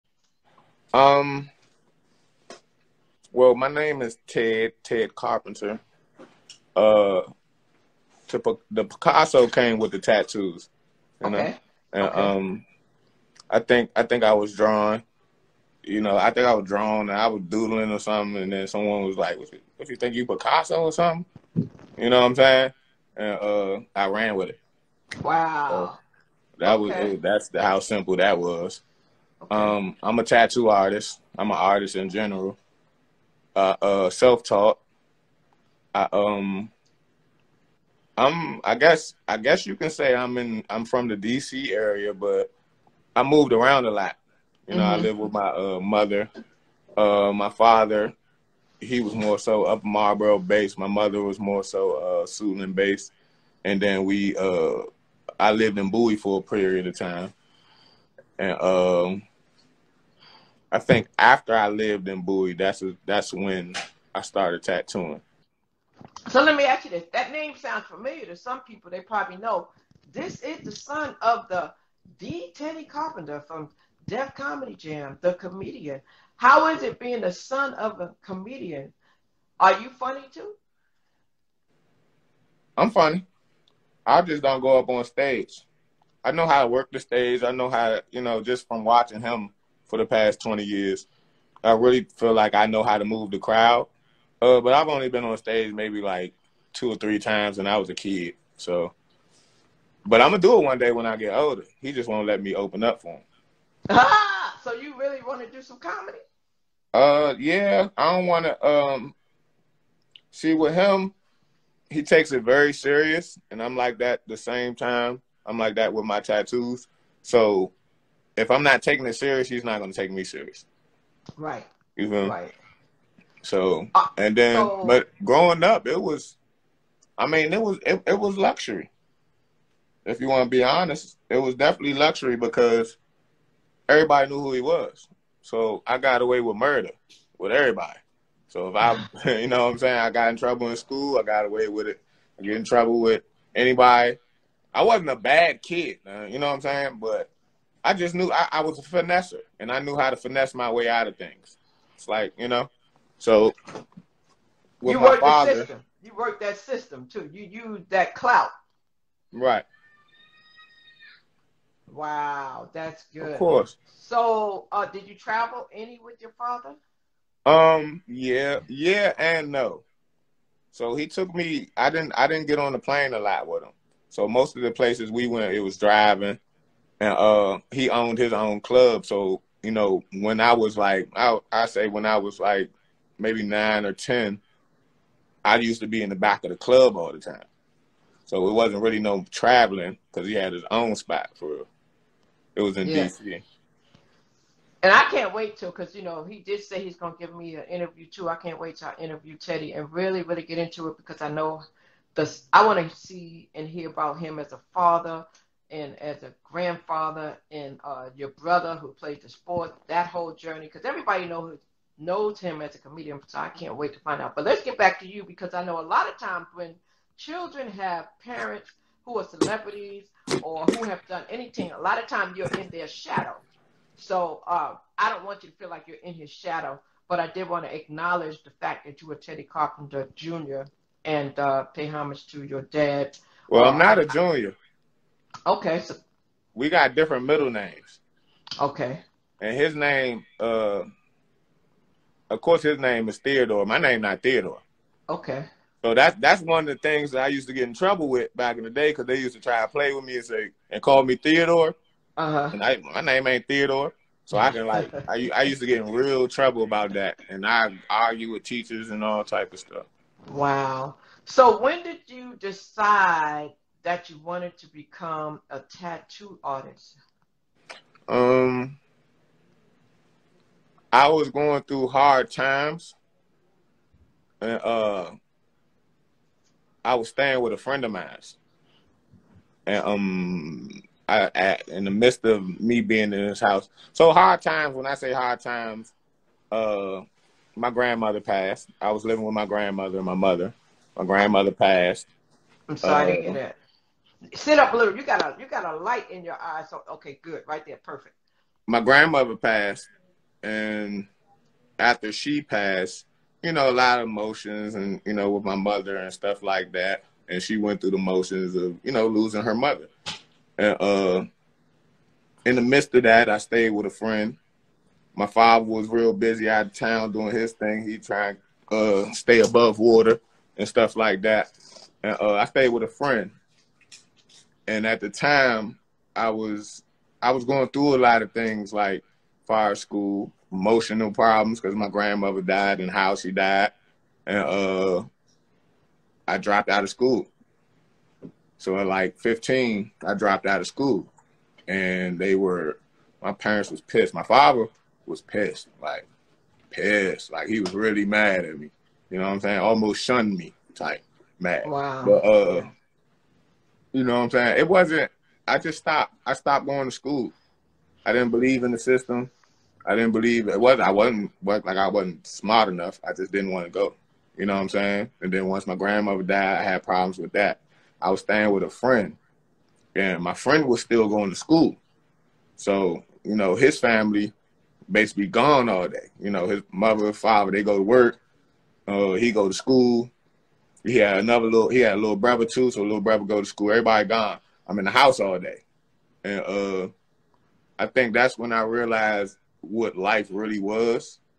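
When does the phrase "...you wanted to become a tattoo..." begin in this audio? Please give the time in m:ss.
4:24.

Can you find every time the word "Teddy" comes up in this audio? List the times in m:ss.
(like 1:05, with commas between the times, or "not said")
1:12, 3:19, 3:49.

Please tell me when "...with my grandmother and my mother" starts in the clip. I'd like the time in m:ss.
4:49.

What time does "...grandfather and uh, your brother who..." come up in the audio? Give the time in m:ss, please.
3:26.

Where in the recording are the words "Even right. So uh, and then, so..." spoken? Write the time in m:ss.
2:01.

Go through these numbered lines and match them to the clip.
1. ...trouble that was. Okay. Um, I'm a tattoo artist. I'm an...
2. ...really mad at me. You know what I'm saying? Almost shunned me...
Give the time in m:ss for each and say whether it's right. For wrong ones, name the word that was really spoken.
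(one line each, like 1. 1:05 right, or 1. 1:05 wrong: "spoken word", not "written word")
1. 0:27 wrong: "simple", not "trouble"
2. 5:47 right.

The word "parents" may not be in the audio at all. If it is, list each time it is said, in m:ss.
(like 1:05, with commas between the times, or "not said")
3:38, 5:43.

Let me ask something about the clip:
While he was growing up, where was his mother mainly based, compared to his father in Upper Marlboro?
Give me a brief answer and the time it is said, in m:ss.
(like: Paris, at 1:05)
Suitland, at 0:52.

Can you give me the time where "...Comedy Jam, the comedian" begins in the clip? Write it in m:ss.
1:14.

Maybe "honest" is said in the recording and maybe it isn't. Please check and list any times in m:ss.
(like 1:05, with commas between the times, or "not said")
2:10.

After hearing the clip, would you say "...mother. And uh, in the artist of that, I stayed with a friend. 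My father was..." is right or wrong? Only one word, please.
wrong.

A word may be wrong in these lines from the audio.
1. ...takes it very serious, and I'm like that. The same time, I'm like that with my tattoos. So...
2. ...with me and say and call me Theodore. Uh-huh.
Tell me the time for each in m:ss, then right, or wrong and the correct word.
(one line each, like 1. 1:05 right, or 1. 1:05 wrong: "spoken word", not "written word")
1. 1:52 right
2. 4:09 right.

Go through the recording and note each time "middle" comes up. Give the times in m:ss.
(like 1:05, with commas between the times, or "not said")
3:57.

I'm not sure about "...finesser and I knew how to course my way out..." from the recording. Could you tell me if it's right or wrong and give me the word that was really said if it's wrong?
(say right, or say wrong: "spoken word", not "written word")
wrong: "finesse", not "course".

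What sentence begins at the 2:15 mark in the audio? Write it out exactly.
So I got away with murder with everybody.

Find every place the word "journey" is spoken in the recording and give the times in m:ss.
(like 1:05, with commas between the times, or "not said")
3:30.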